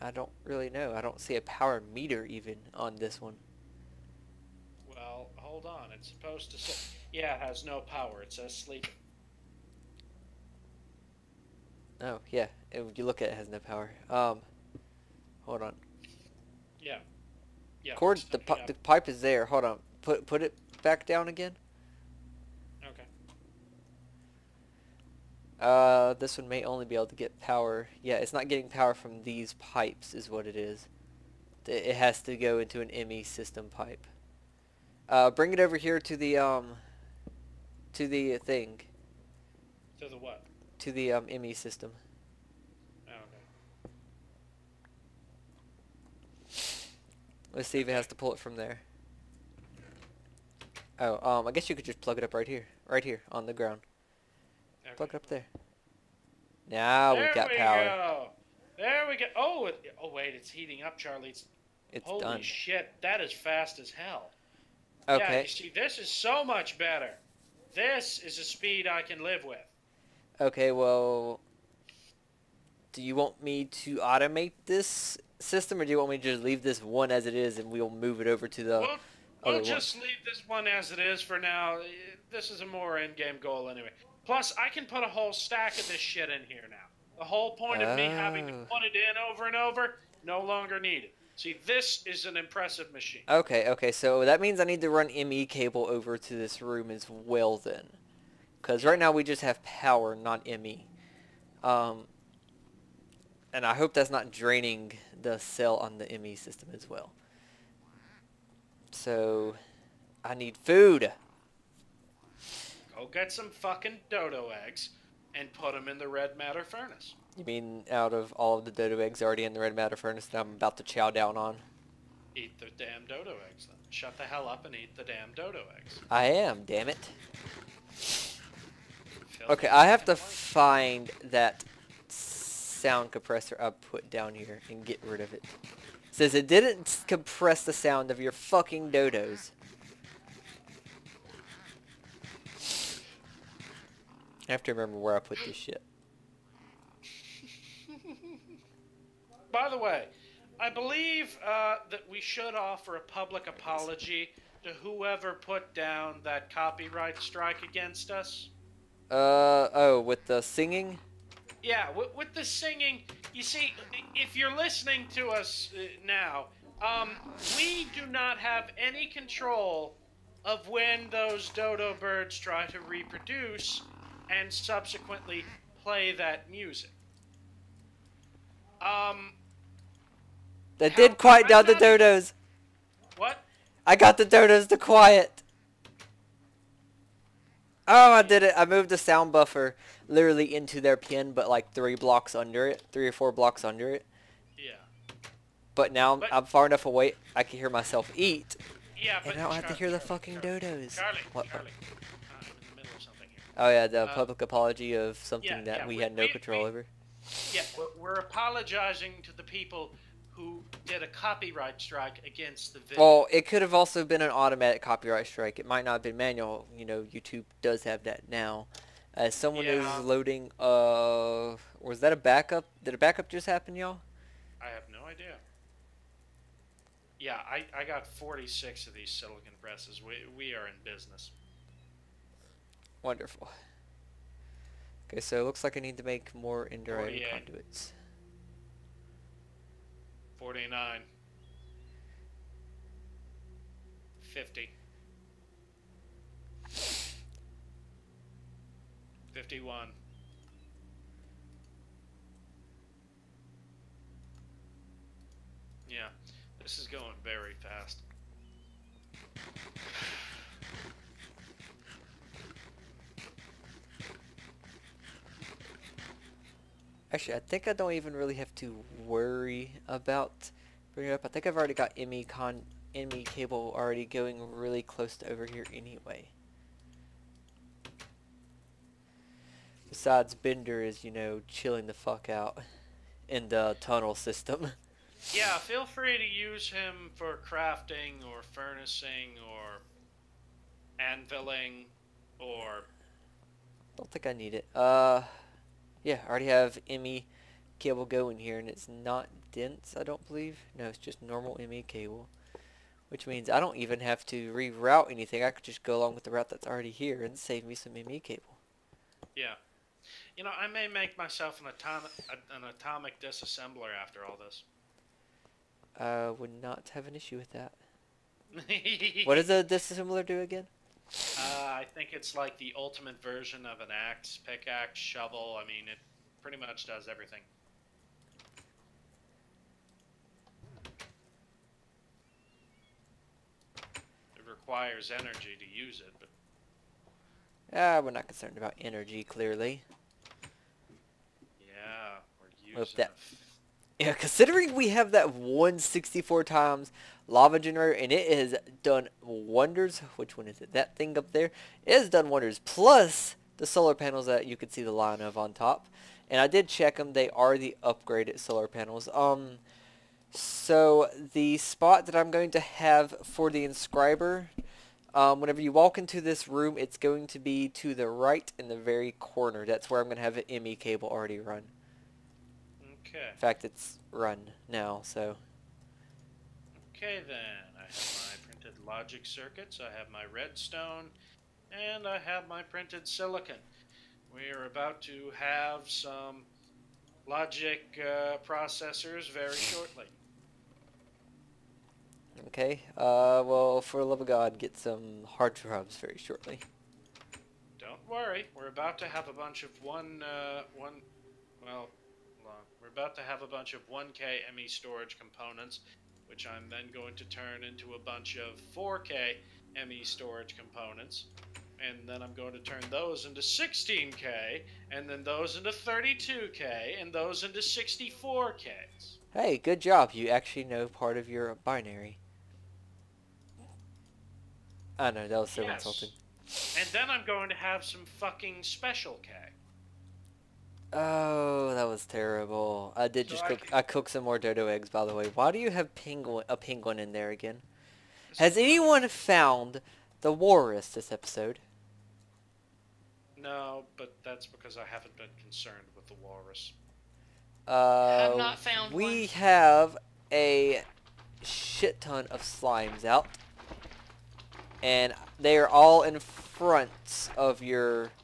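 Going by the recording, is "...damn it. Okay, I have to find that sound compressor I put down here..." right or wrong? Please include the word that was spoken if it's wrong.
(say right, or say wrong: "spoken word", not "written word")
right.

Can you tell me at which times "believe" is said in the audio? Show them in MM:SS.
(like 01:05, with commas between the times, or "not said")
02:30, 05:00.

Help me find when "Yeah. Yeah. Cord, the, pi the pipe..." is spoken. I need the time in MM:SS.
00:16.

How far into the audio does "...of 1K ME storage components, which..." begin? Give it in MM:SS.
06:43.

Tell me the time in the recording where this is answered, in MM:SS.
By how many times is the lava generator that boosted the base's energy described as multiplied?
05:45.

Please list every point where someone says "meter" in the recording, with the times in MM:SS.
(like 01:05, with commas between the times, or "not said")
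00:01.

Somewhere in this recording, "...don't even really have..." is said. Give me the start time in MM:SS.
04:27.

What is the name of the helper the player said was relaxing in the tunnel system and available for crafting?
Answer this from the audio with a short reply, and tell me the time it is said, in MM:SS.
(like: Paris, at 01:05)
Bender, at 04:40.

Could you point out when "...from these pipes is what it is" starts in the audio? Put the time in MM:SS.
00:28.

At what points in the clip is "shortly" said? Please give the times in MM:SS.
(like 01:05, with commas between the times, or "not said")
06:29, 06:36.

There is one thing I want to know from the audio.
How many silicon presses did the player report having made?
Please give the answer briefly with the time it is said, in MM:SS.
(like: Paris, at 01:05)
46, at 03:48.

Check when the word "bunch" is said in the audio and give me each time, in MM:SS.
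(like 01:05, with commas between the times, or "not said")
06:39, 06:43, 06:47.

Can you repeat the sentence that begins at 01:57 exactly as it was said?
You mean out of all of the dodo eggs already in the red matter furnace that I'm about to chow down on?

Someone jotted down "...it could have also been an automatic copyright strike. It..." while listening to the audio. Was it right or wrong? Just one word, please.
right.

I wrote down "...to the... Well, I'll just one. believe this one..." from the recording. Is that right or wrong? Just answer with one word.
wrong.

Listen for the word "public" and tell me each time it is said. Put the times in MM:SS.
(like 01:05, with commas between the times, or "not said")
02:33, 03:24.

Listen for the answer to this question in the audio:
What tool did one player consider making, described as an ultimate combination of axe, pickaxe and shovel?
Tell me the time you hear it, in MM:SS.
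05:12.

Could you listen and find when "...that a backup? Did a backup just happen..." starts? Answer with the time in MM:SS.
03:42.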